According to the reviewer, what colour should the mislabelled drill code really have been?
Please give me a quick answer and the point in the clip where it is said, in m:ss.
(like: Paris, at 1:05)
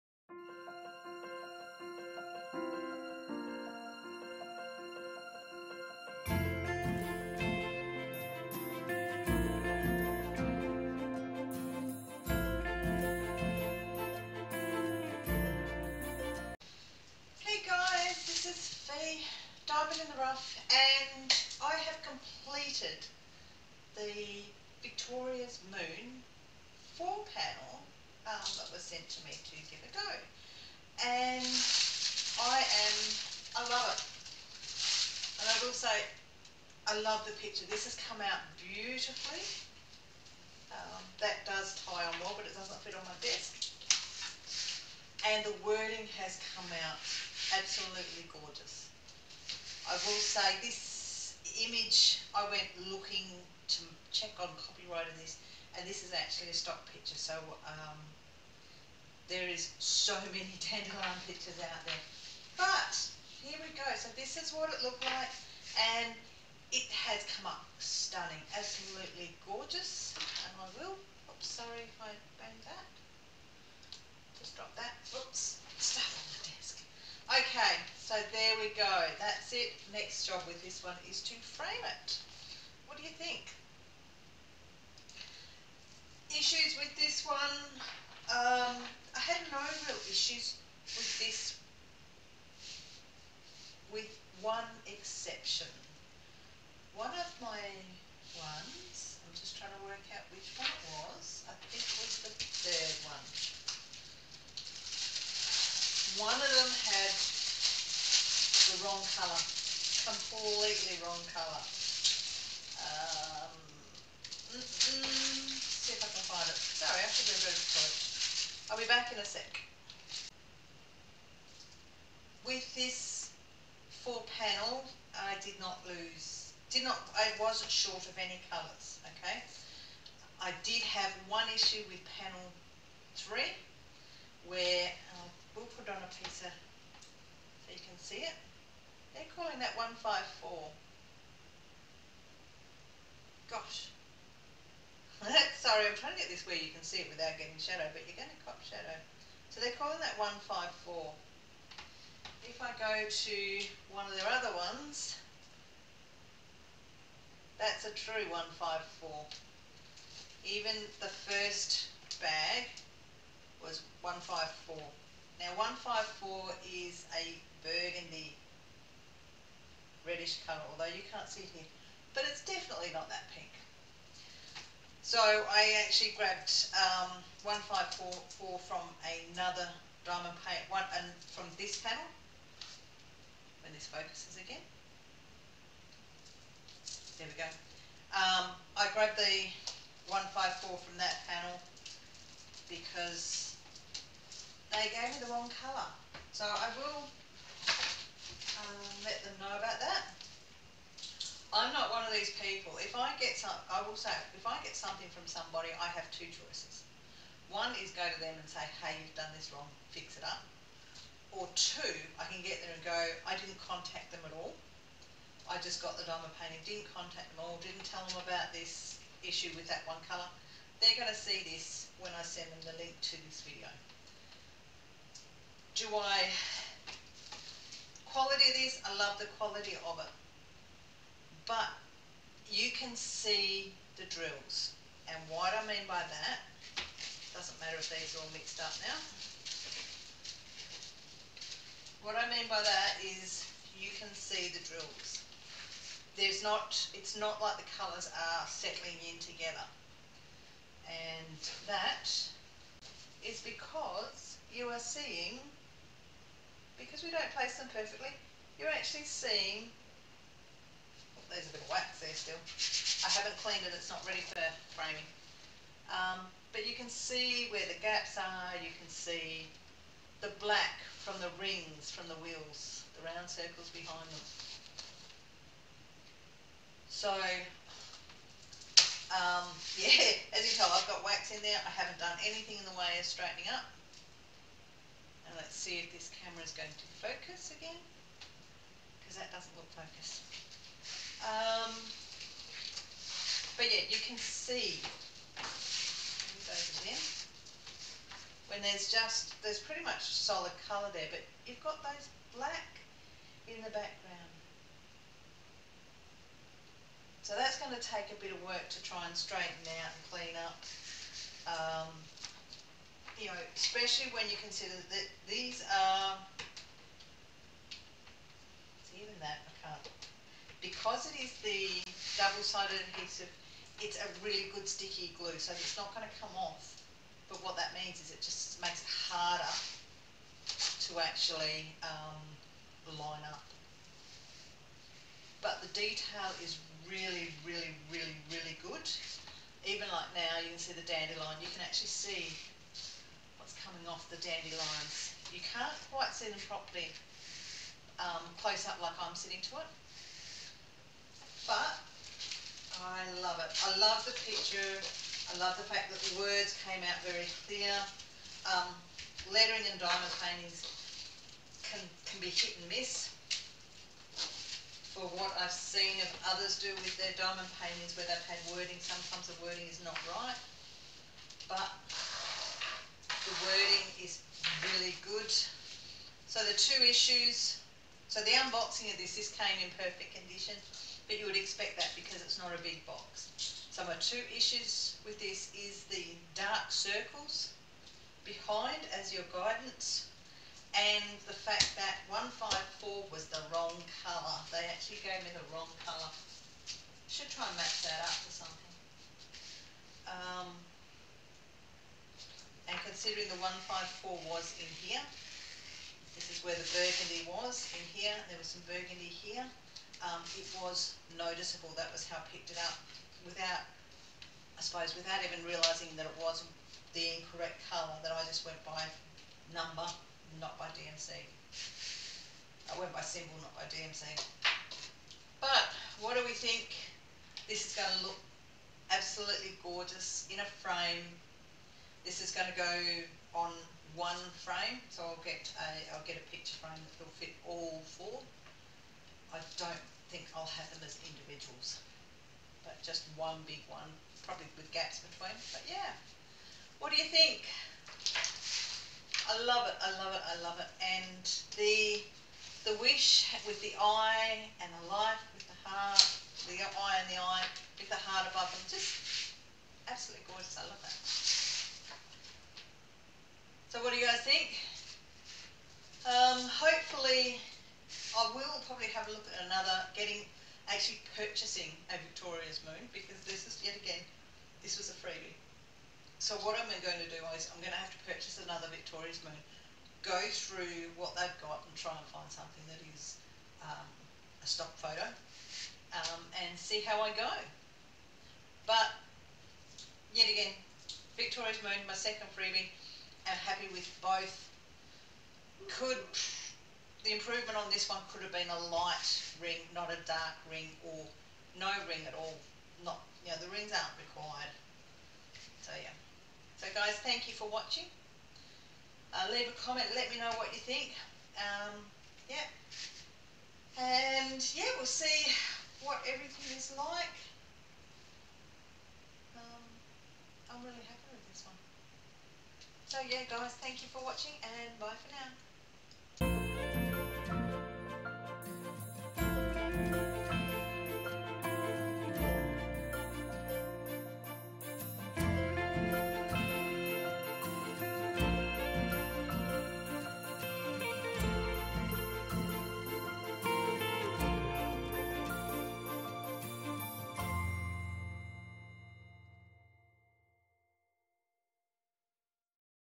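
Burgundy reddish, at 2:47.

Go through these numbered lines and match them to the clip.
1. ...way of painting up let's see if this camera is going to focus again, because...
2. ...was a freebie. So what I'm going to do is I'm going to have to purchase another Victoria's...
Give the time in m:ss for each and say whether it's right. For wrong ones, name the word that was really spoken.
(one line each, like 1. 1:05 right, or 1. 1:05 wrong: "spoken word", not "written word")
1. 4:42 wrong: "straightening", not "painting"
2. 7:54 right.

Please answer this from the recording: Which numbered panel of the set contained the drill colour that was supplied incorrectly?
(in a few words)
Panel three.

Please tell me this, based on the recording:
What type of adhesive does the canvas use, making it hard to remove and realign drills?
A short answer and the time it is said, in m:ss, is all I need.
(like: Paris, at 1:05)
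Double-sided adhesive, at 5:22.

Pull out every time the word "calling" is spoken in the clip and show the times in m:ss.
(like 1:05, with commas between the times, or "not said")
2:19, 2:29.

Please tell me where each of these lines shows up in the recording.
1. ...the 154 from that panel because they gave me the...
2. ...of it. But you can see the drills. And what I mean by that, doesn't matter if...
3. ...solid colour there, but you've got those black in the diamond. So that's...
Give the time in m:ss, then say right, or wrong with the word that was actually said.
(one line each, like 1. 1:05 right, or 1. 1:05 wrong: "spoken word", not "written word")
1. 3:09 right
2. 3:49 right
3. 5:00 wrong: "background", not "diamond".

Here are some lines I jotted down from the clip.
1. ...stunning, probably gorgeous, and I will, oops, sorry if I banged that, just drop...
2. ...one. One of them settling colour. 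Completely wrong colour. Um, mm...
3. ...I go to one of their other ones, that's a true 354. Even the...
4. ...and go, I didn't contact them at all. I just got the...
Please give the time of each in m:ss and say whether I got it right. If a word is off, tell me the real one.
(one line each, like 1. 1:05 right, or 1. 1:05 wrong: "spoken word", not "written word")
1. 1:07 wrong: "absolutely", not "probably"
2. 1:46 wrong: "wrong", not "settling"
3. 2:32 wrong: "154", not "354"
4. 3:32 right.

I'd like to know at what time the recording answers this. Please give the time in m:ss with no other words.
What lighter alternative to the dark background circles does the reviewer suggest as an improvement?
8:18.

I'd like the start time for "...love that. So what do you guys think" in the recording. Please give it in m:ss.
7:40.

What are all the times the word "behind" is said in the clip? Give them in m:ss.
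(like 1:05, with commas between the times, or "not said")
4:33, 6:28.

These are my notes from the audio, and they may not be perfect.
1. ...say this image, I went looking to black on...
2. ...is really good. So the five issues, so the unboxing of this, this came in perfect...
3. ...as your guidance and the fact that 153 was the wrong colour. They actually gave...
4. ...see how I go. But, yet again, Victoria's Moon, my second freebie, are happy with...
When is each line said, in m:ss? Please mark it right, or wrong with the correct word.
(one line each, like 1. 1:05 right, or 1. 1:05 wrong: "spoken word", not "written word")
1. 0:50 wrong: "check", not "black"
2. 6:14 wrong: "two", not "five"
3. 6:28 wrong: "154", not "153"
4. 8:06 right.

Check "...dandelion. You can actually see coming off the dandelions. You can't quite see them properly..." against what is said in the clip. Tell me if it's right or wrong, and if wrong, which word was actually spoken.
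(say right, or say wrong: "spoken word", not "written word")
right.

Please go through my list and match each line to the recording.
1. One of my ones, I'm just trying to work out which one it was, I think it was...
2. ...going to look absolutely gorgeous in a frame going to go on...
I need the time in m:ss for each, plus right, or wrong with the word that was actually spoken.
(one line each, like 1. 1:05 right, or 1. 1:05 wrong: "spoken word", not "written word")
1. 1:36 right
2. 7:07 right.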